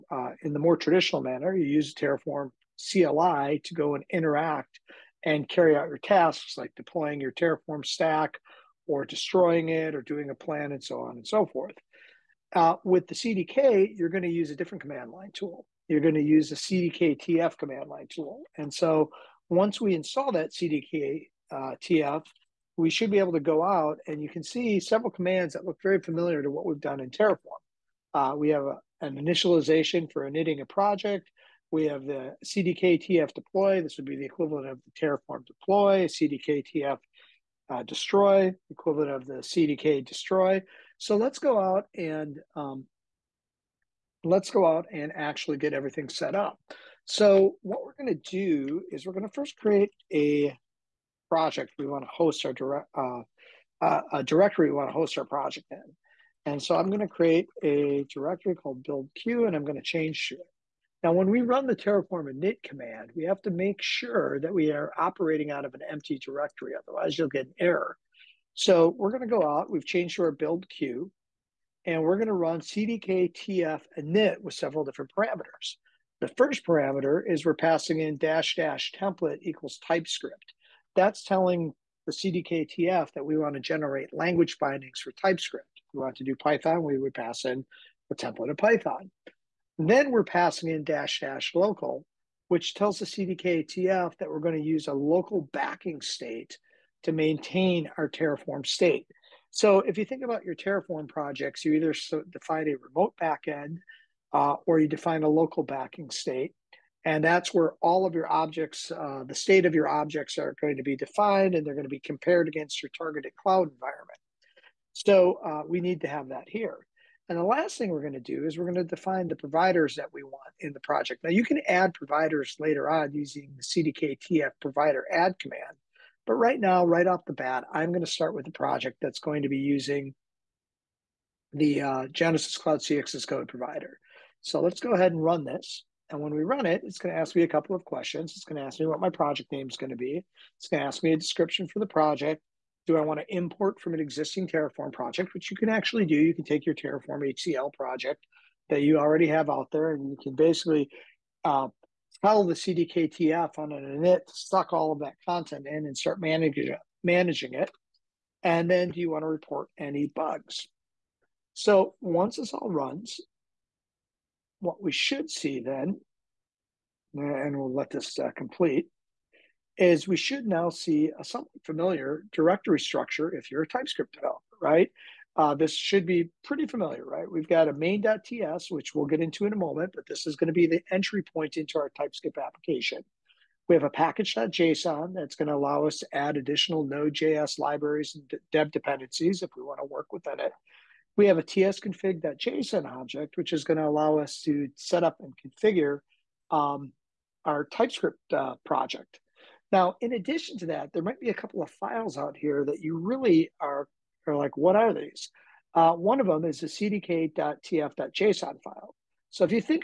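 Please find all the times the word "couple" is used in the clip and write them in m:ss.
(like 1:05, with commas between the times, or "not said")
2:17, 3:21.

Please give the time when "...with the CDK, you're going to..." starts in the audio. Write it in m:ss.
0:12.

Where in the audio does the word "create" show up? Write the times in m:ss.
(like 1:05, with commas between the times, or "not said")
0:49, 0:57.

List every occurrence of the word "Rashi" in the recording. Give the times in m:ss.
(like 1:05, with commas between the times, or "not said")
not said.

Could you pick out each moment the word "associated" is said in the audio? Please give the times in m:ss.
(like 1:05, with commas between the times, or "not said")
not said.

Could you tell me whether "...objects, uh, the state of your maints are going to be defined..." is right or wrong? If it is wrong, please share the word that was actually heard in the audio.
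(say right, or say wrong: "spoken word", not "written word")
wrong: "objects", not "maints".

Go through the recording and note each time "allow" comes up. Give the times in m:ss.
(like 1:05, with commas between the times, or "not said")
3:05, 3:13.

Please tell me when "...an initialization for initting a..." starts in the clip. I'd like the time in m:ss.
0:29.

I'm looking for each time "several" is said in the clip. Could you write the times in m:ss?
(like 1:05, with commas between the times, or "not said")
0:24, 1:14.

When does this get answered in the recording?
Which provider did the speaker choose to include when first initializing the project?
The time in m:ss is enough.
2:12.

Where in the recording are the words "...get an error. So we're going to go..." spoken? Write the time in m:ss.
1:07.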